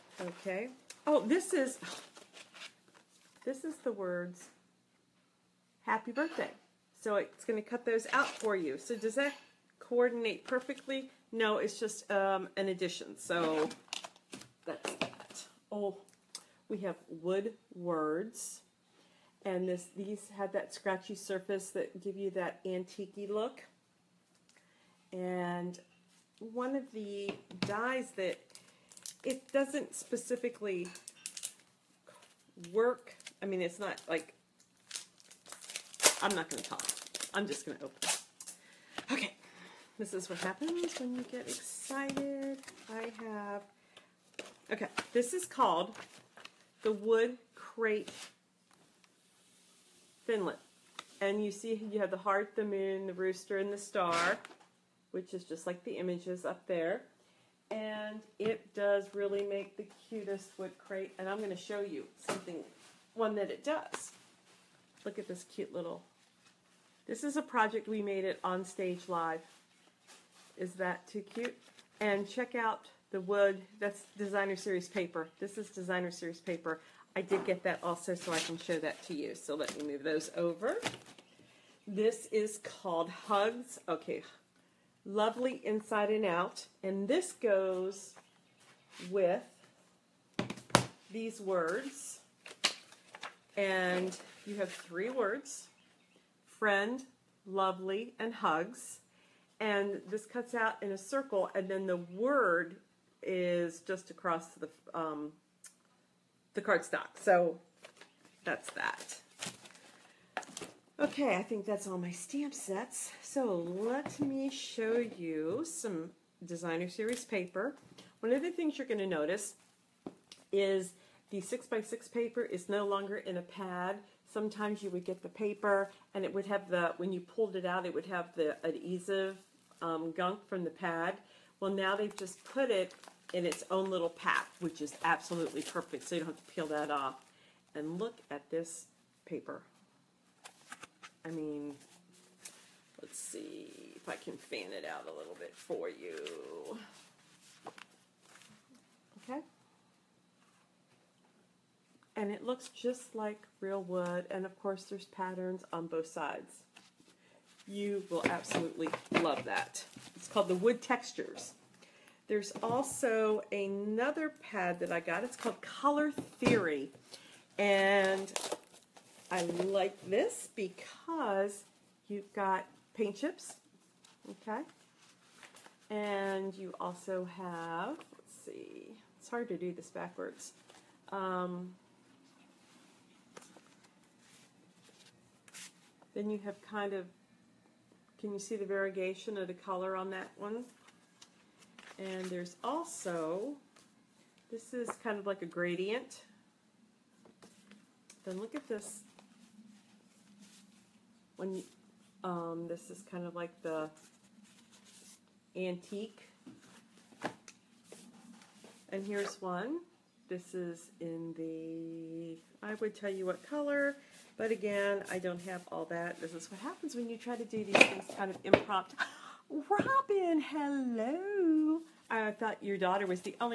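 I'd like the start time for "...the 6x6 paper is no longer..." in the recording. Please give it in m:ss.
2:01.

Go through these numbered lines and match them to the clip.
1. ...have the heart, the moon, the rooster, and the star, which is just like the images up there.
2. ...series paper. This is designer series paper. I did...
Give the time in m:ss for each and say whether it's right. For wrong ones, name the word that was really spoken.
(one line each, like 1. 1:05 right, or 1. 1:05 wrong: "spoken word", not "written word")
1. 0:51 right
2. 1:14 right.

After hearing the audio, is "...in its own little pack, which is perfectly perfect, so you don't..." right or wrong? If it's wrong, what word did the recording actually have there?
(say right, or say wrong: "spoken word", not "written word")
wrong: "absolutely", not "perfectly".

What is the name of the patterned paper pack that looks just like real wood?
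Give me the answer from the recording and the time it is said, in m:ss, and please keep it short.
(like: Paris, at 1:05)
Wood Textures, at 2:40.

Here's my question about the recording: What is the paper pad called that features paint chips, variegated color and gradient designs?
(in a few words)
Color Theory.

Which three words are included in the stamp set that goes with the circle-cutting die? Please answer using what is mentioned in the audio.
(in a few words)
friend, lovely, and hugs.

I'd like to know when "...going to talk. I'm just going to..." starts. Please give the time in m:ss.
0:36.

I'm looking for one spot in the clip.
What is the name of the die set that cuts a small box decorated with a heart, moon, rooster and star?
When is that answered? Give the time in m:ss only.
0:46.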